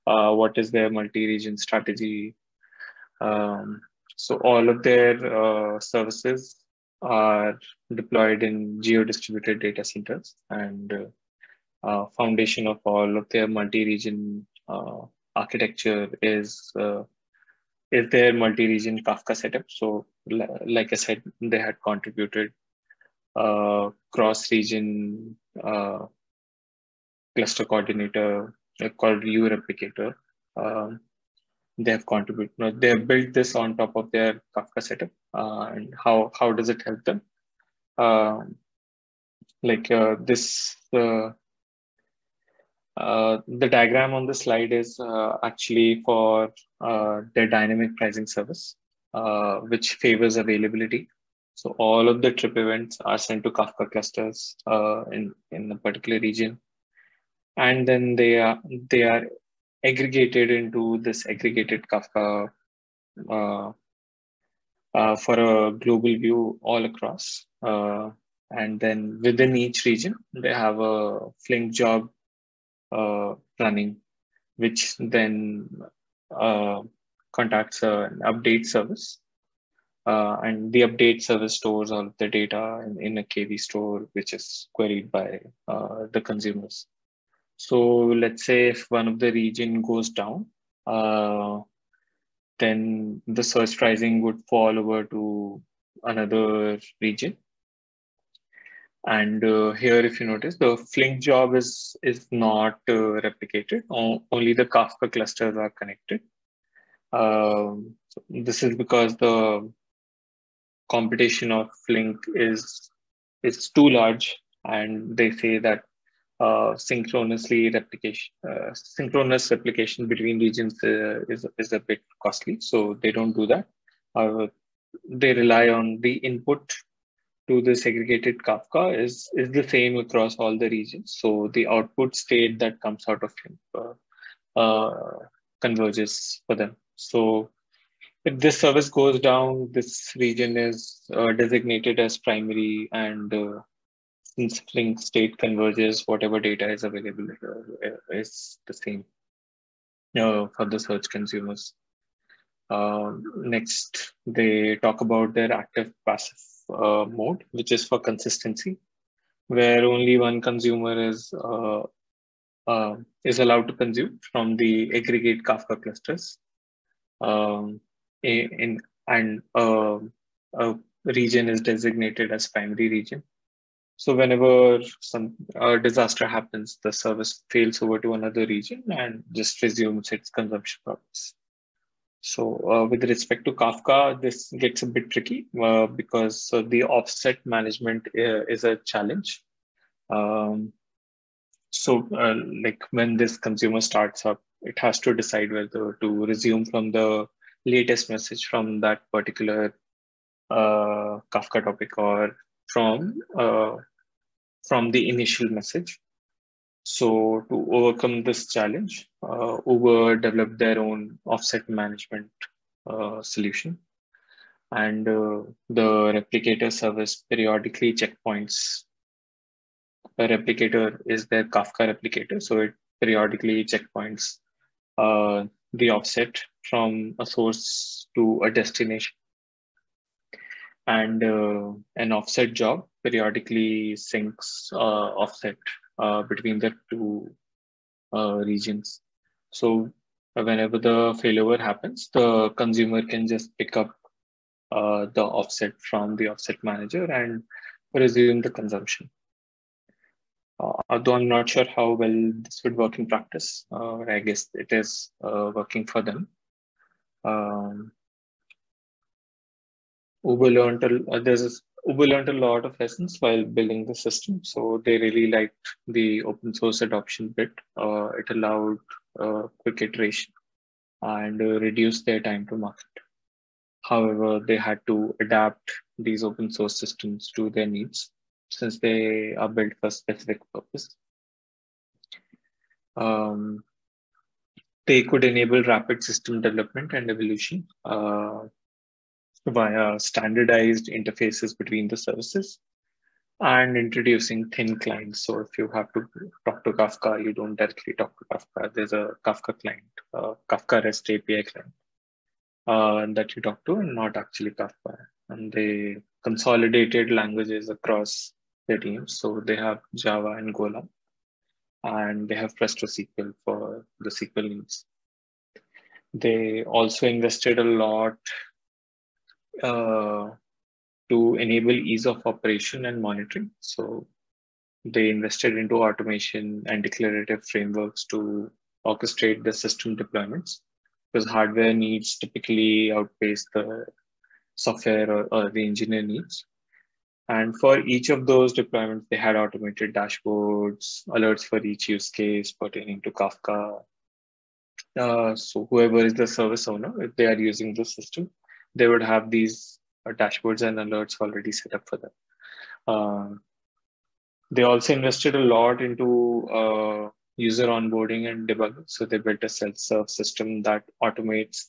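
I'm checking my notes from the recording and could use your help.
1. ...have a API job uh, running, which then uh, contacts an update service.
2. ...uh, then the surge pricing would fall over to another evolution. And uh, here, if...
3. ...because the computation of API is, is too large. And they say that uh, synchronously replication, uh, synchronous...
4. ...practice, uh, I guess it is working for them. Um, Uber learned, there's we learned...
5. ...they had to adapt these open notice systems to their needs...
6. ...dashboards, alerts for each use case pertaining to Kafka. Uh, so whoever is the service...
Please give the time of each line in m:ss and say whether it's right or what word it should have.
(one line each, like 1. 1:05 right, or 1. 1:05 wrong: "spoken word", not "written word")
1. 1:10 wrong: "Flink", not "API"
2. 1:30 wrong: "region", not "evolution"
3. 1:48 wrong: "Flink", not "API"
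4. 4:13 right
5. 4:34 wrong: "source", not "notice"
6. 5:39 right.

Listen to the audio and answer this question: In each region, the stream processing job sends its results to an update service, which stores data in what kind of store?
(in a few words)
KV store.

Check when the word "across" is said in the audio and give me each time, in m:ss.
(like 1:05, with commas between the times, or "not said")
1:06, 2:09, 5:07.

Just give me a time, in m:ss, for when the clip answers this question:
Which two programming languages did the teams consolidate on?
5:09.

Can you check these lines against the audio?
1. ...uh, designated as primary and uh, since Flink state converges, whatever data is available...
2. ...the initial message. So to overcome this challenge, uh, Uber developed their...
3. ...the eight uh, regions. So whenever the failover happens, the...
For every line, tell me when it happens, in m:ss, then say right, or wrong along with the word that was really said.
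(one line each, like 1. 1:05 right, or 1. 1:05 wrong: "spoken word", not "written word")
1. 2:21 right
2. 3:24 right
3. 3:56 wrong: "two", not "eight".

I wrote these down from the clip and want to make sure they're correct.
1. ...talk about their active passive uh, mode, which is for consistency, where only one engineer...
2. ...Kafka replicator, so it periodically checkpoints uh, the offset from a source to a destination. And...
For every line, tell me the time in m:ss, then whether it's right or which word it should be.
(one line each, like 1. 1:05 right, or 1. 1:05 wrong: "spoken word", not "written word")
1. 2:34 wrong: "consumer", not "engineer"
2. 3:41 right.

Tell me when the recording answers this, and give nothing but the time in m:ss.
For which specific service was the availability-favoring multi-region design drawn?
0:47.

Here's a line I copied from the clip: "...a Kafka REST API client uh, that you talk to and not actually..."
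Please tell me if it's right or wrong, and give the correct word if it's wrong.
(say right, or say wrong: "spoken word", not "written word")
right.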